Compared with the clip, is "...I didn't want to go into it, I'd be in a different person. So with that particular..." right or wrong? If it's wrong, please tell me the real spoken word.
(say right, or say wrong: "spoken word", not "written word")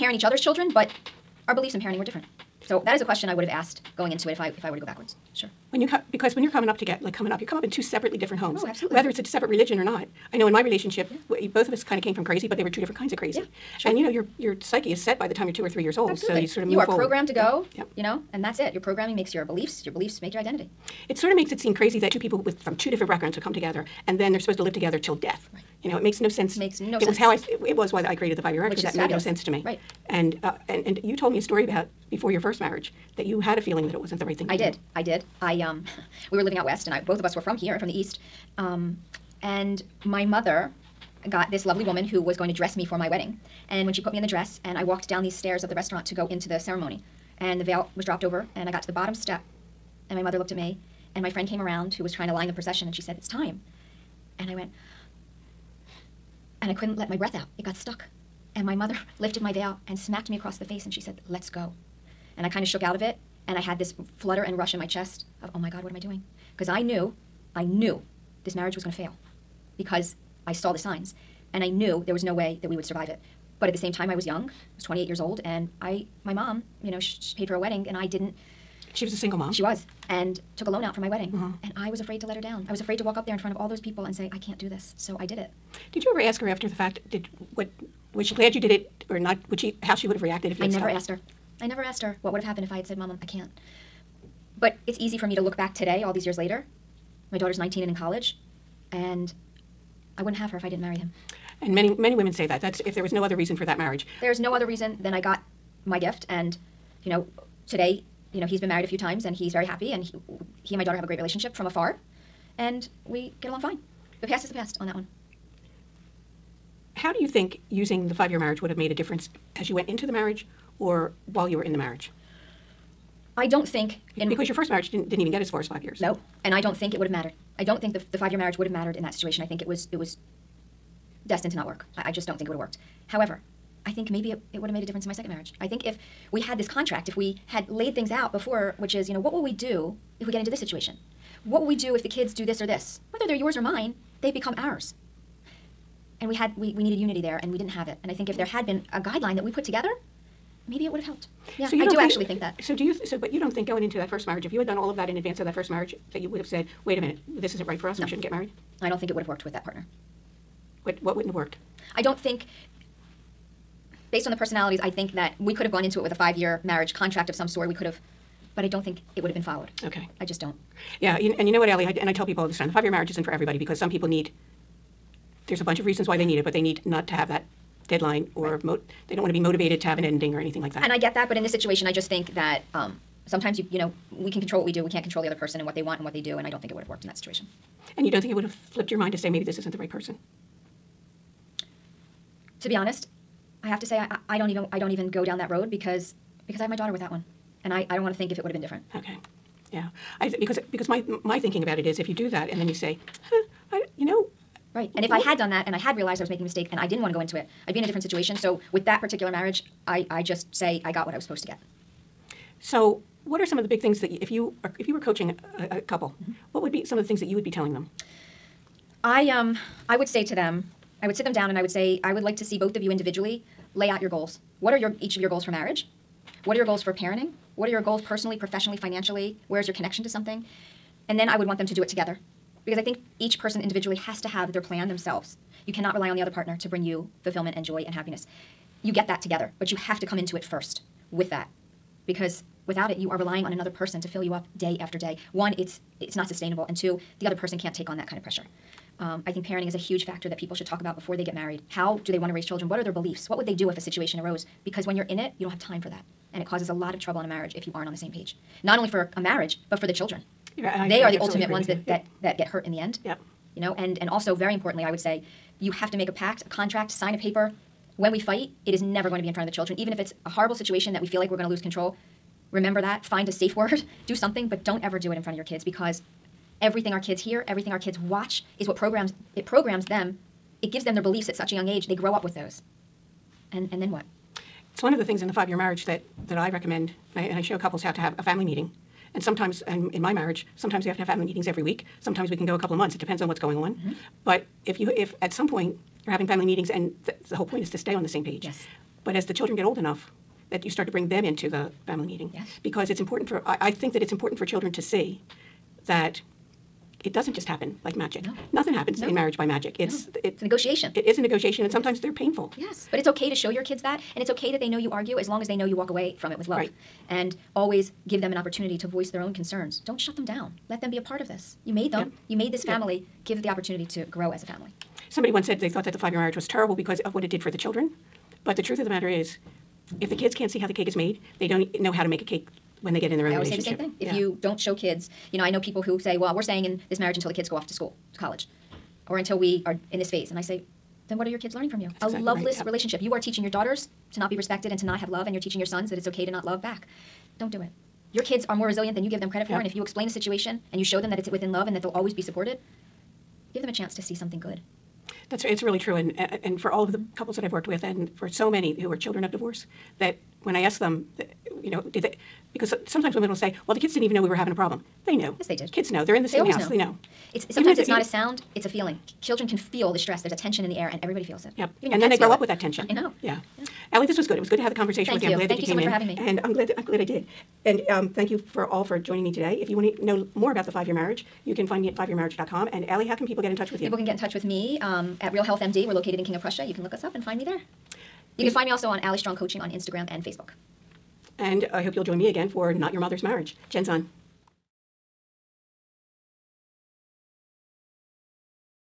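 wrong: "situation", not "person".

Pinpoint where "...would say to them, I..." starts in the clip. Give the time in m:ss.
3:39.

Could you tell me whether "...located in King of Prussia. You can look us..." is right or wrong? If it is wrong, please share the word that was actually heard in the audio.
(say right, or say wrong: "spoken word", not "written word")
right.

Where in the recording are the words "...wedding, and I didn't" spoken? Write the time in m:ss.
1:17.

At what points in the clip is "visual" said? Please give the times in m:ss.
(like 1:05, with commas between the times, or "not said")
not said.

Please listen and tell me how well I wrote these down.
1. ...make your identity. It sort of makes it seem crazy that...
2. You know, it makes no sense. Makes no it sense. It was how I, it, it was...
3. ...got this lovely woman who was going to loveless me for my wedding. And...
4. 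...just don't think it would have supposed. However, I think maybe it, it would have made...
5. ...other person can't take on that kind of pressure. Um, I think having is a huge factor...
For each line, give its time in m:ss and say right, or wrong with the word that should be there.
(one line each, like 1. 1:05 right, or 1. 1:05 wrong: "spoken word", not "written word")
1. 0:20 right
2. 0:25 right
3. 0:41 wrong: "dress", not "loveless"
4. 2:12 wrong: "worked", not "supposed"
5. 4:07 wrong: "parenting", not "having".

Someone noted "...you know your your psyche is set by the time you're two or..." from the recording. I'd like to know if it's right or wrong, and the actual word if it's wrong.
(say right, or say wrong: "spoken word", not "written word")
right.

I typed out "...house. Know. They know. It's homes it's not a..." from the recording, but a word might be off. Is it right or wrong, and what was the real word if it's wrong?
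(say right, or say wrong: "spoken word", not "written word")
wrong: "sometimes", not "homes".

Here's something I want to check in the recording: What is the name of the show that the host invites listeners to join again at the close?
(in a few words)
Not Your Mother's Marriage.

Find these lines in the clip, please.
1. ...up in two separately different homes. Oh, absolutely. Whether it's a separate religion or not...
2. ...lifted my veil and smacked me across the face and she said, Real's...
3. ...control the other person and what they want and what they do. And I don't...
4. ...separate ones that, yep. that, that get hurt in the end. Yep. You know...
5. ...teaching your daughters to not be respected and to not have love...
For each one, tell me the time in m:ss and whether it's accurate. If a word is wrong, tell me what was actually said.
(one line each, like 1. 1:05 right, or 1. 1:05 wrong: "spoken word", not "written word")
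1. 0:07 right
2. 0:59 wrong: "Let", not "Real"
3. 3:05 right
4. 4:21 wrong: "ultimate", not "separate"
5. 5:43 right.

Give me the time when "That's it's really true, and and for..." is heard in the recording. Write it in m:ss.
5:55.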